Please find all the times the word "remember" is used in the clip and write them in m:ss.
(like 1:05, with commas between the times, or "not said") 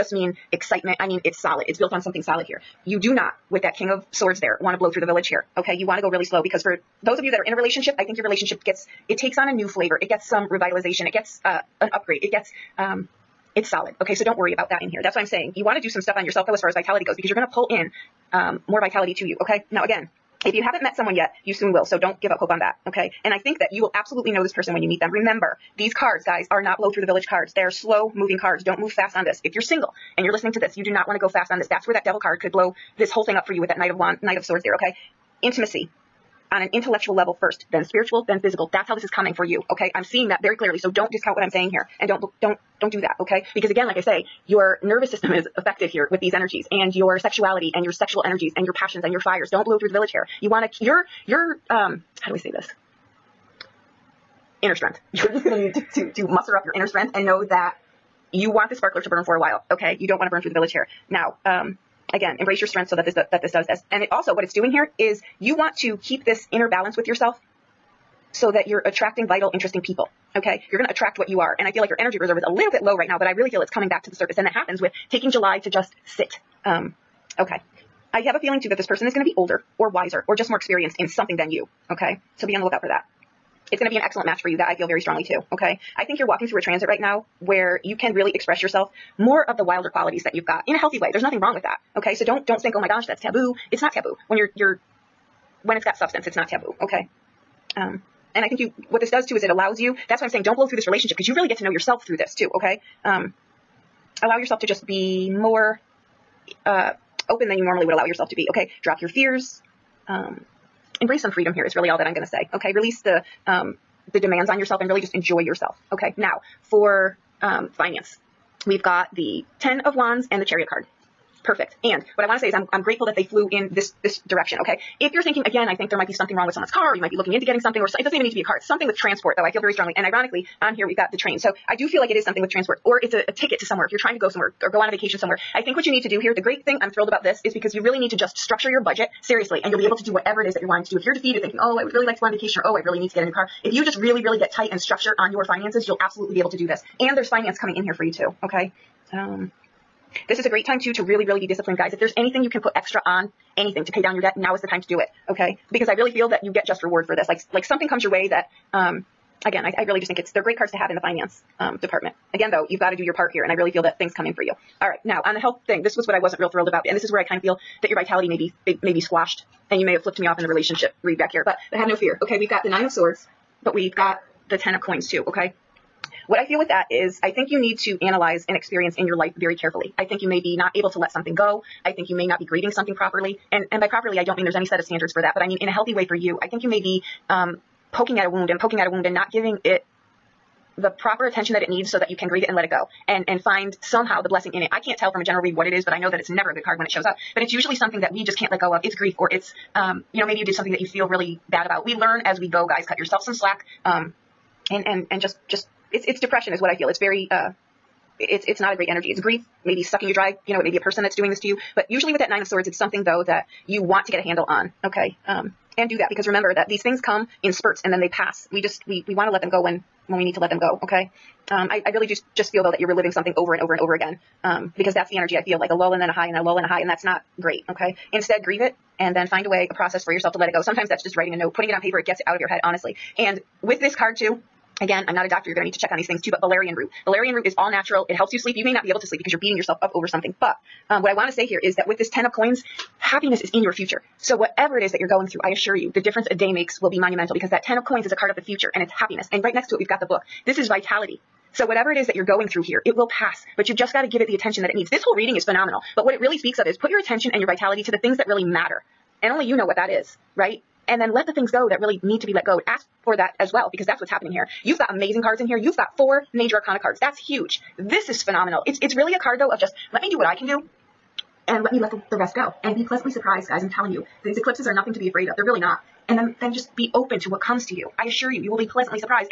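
0:25, 3:36.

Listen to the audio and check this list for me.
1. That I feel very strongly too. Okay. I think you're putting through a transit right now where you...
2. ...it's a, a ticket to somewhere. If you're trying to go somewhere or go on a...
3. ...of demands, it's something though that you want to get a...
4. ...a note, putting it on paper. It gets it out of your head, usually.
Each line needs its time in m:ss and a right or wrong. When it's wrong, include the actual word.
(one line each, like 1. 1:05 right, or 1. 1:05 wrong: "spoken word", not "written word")
1. 1:24 wrong: "walking", not "putting"
2. 2:13 right
3. 3:32 wrong: "swords", not "demands"
4. 3:51 wrong: "honestly", not "usually".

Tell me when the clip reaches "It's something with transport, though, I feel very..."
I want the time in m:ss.
2:08.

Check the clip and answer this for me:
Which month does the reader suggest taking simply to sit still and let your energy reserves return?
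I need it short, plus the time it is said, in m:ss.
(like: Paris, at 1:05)
July, at 1:15.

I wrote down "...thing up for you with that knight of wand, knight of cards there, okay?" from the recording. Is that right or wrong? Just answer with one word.
wrong.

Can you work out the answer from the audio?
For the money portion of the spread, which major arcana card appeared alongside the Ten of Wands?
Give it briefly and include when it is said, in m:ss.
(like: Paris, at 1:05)
The Chariot, at 2:00.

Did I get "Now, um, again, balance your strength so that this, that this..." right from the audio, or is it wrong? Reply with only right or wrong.
wrong.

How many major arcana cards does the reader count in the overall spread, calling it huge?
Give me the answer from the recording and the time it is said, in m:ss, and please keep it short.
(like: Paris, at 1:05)
4, at 4:25.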